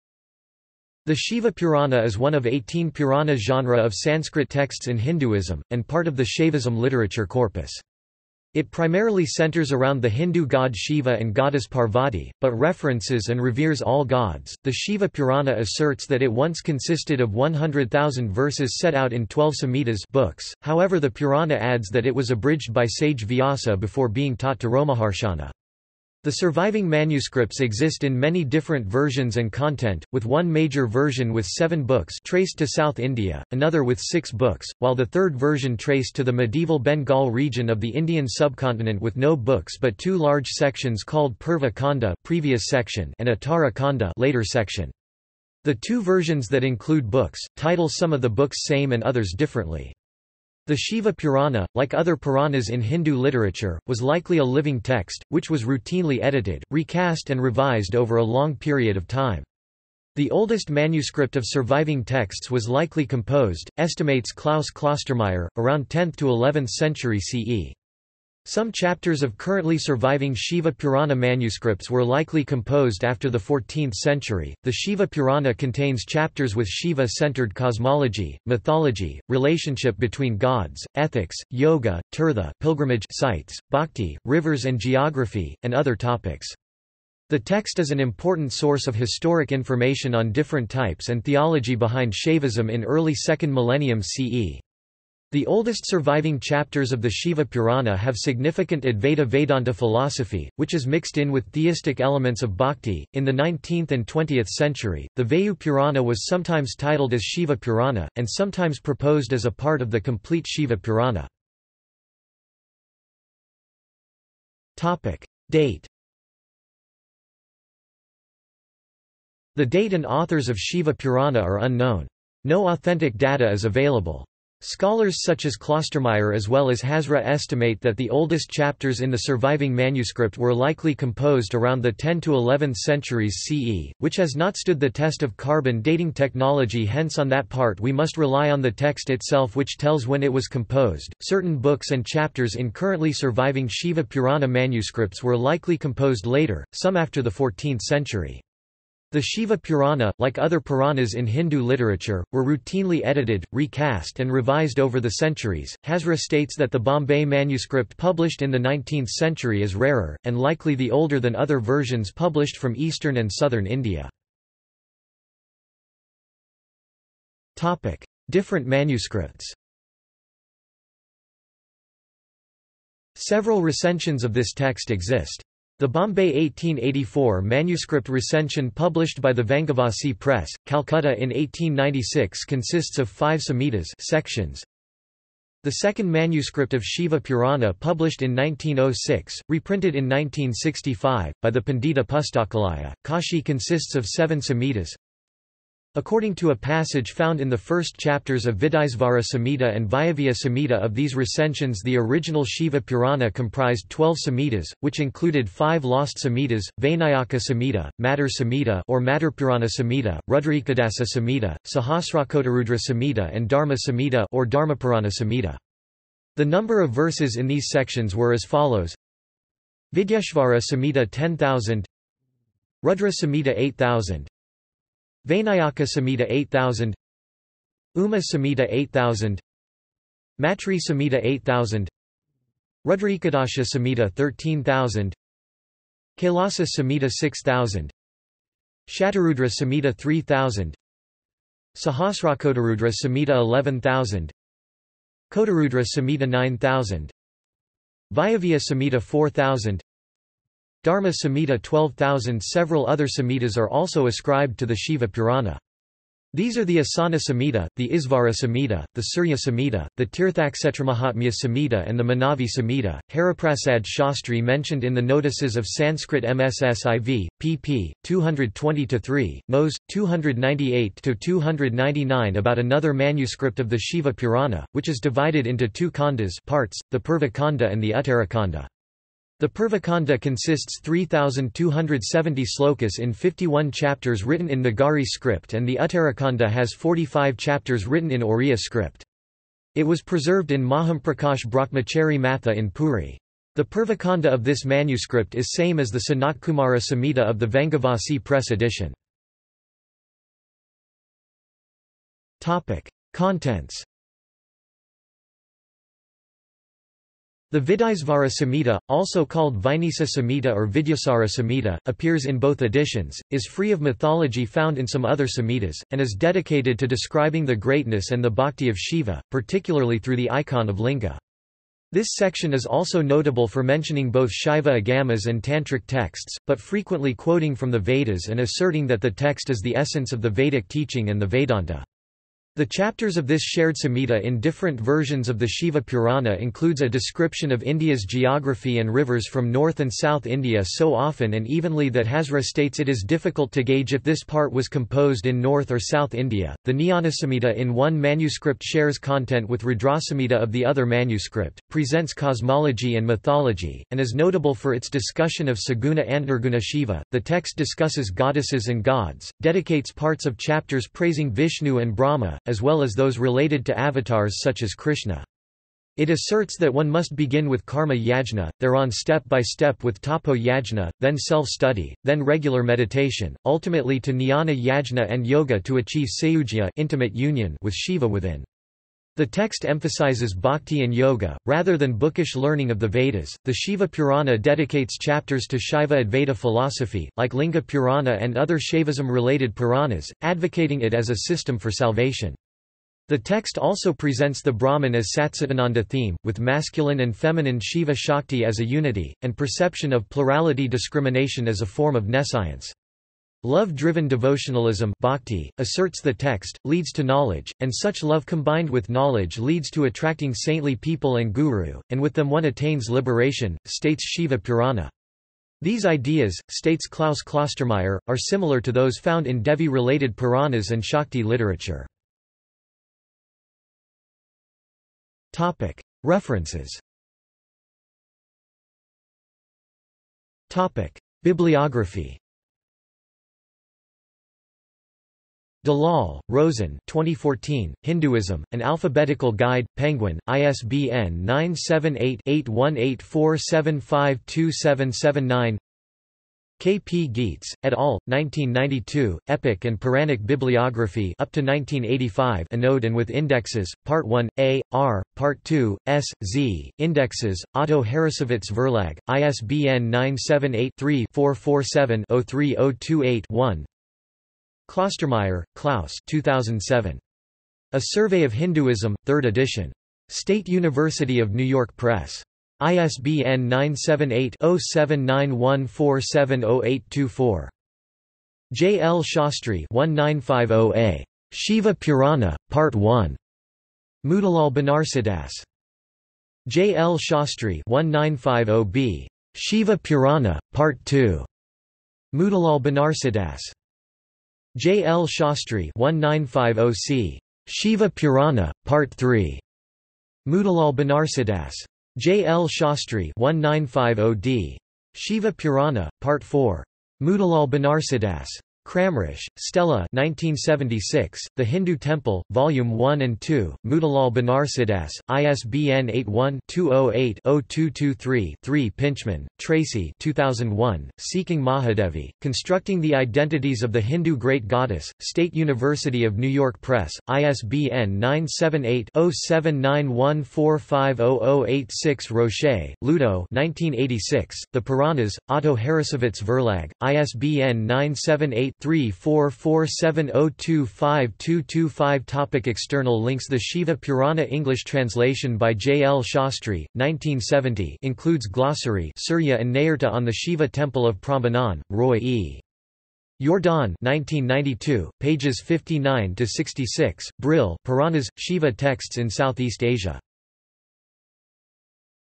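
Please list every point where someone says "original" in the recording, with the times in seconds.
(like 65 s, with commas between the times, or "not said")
201 s.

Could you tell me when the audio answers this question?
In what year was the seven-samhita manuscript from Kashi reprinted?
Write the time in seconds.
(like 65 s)
190 s.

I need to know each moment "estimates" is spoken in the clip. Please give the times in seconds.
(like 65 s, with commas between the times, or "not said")
63 s, 127 s.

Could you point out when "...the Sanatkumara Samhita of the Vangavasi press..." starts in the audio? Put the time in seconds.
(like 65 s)
295 s.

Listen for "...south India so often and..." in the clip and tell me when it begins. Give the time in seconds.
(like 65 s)
339 s.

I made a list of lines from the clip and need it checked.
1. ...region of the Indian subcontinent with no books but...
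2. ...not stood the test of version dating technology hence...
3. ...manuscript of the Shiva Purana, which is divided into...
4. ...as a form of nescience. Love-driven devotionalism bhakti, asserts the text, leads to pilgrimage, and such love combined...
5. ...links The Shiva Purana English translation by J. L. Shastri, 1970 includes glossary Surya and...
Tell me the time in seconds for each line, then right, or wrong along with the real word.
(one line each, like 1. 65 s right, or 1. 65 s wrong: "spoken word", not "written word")
1. 37 s right
2. 134 s wrong: "carbon", not "version"
3. 272 s right
4. 401 s wrong: "knowledge", not "pilgrimage"
5. 543 s right.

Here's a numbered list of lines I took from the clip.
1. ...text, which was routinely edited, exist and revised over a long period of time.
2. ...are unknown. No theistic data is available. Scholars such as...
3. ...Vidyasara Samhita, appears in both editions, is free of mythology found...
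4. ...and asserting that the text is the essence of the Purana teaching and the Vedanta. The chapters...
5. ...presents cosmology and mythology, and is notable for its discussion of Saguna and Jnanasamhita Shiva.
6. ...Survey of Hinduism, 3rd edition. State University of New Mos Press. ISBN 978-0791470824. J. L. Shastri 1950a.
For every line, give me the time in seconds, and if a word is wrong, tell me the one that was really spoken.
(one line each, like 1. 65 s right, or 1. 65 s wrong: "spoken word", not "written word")
1. 54 s wrong: "recast", not "exist"
2. 121 s wrong: "authentic", not "theistic"
3. 310 s right
4. 328 s wrong: "Vedic", not "Purana"
5. 351 s wrong: "Nirguna", not "Jnanasamhita"
6. 467 s wrong: "York", not "Mos".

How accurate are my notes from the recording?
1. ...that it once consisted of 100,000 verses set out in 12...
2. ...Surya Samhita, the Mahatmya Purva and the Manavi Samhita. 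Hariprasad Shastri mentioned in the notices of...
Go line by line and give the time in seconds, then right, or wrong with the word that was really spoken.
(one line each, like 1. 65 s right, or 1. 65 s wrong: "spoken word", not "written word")
1. 16 s right
2. 259 s wrong: "Samhita", not "Purva".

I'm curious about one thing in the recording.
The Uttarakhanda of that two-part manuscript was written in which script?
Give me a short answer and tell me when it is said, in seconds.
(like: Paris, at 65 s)
Oriya, at 288 s.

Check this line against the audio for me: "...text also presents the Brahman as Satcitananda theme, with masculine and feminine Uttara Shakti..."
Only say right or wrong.
wrong.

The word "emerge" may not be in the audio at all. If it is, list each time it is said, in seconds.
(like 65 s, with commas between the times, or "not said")
not said.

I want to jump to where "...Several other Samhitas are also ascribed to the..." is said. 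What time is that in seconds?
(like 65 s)
252 s.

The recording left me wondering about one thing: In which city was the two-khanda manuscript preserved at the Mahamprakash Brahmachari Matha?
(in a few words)
Puri.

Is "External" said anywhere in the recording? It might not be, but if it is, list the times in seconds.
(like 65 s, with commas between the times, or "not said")
542 s.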